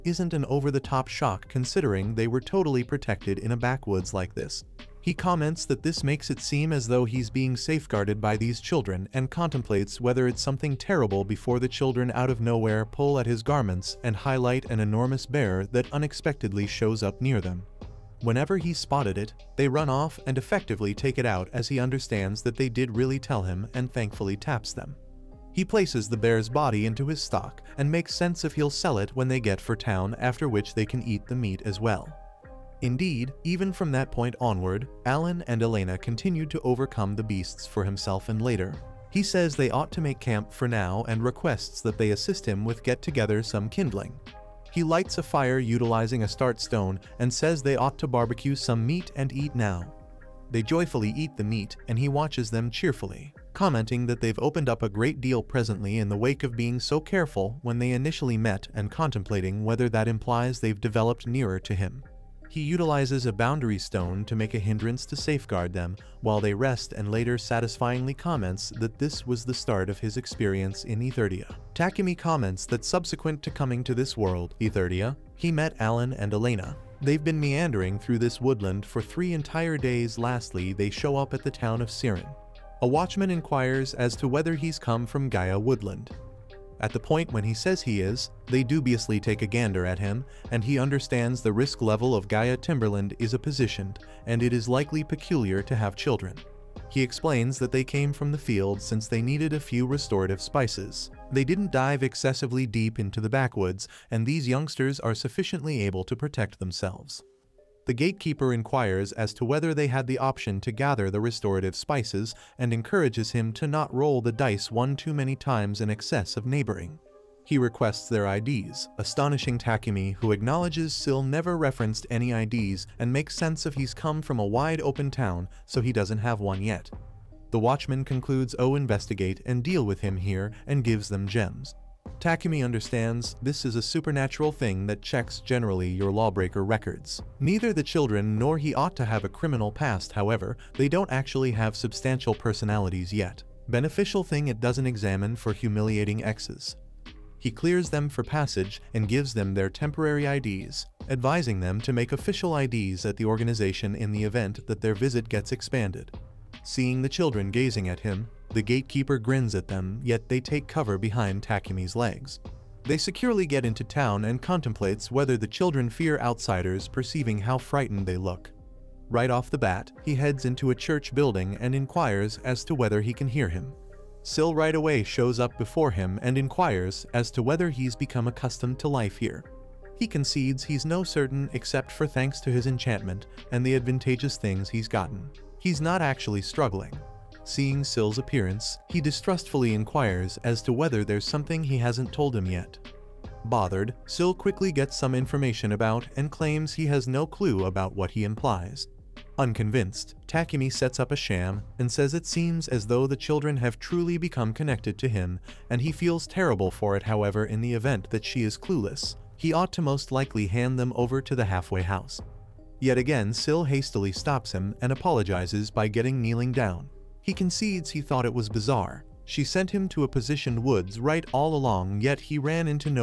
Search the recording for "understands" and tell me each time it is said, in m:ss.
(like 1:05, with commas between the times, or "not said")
0:21, 1:30, 2:12.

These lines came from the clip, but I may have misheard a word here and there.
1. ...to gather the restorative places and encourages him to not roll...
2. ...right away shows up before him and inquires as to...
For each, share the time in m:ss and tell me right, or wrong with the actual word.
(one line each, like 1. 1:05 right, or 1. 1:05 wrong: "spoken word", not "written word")
1. 1:50 wrong: "spices", not "places"
2. 2:54 right.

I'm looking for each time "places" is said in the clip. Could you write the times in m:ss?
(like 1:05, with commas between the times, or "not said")
0:25.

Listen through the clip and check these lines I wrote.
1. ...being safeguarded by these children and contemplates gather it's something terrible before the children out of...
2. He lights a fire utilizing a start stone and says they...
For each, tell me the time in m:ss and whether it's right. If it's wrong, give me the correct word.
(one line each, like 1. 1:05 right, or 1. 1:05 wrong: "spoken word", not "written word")
1. 0:07 wrong: "whether", not "gather"
2. 0:44 right.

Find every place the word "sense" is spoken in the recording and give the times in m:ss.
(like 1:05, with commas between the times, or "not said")
0:28, 2:03.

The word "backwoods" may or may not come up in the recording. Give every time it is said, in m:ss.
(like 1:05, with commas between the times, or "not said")
0:03, 1:43.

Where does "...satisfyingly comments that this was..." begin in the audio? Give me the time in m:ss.
1:07.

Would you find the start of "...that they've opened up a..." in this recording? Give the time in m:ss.
0:54.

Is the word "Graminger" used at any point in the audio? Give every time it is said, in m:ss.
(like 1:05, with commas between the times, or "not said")
not said.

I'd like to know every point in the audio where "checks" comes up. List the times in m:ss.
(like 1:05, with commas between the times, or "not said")
2:15.